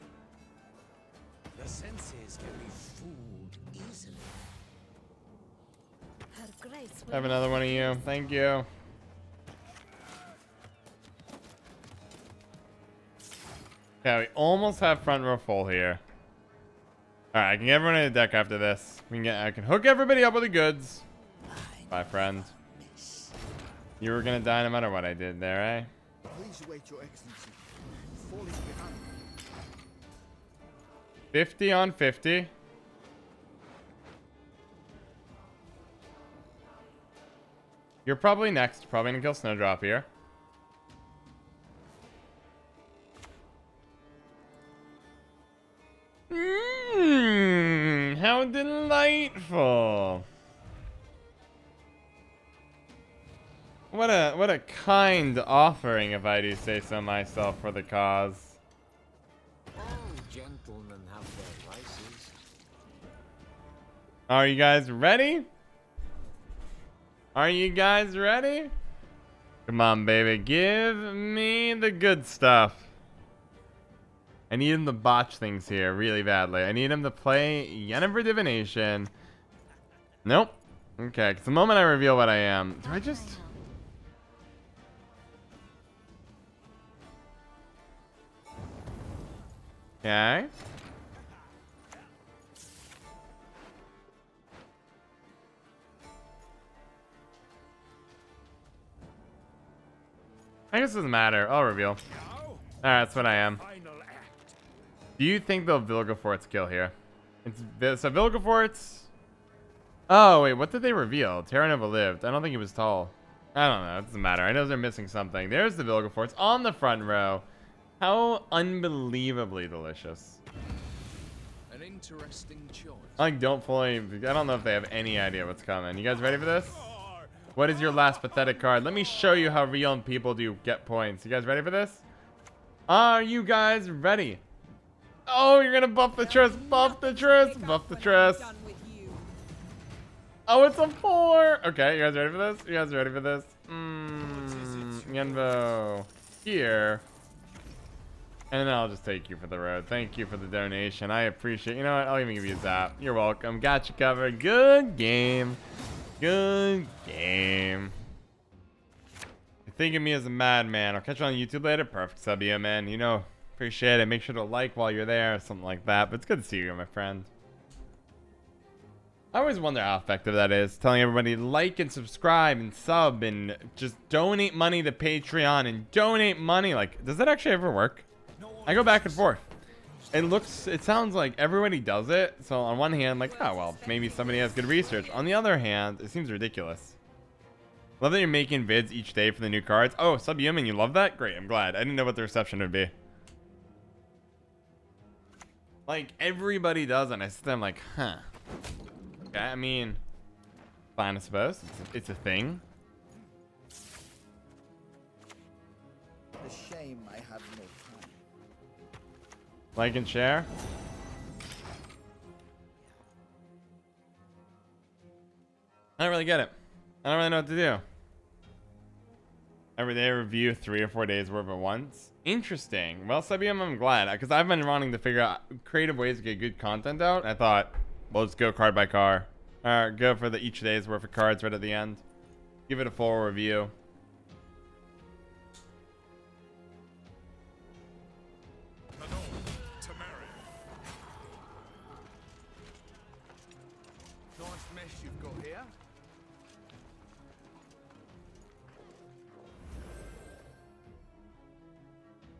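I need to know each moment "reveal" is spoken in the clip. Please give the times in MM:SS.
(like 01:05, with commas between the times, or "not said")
01:21, 01:41, 01:50.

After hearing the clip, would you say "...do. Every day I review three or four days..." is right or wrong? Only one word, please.
right.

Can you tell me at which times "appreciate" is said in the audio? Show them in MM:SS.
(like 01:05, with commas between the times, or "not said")
02:31, 02:43.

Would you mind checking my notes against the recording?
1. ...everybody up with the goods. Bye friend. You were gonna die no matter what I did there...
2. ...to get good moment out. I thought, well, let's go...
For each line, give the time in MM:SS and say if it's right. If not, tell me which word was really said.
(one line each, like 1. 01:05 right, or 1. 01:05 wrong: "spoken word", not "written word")
1. 00:19 right
2. 03:46 wrong: "content", not "moment".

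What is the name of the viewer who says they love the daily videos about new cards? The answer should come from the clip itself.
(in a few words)
Subhuman.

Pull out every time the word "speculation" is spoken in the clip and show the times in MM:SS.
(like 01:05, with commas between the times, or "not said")
not said.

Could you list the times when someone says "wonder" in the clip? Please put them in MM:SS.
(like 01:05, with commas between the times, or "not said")
02:49.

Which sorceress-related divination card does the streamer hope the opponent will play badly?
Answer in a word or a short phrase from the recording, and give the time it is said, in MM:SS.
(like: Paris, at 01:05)
Yennefer Divination, at 01:17.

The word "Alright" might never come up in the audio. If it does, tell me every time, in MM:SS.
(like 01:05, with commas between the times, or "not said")
00:17, 01:41.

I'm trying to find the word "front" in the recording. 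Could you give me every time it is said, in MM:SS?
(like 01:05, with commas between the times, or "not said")
00:15, 01:56.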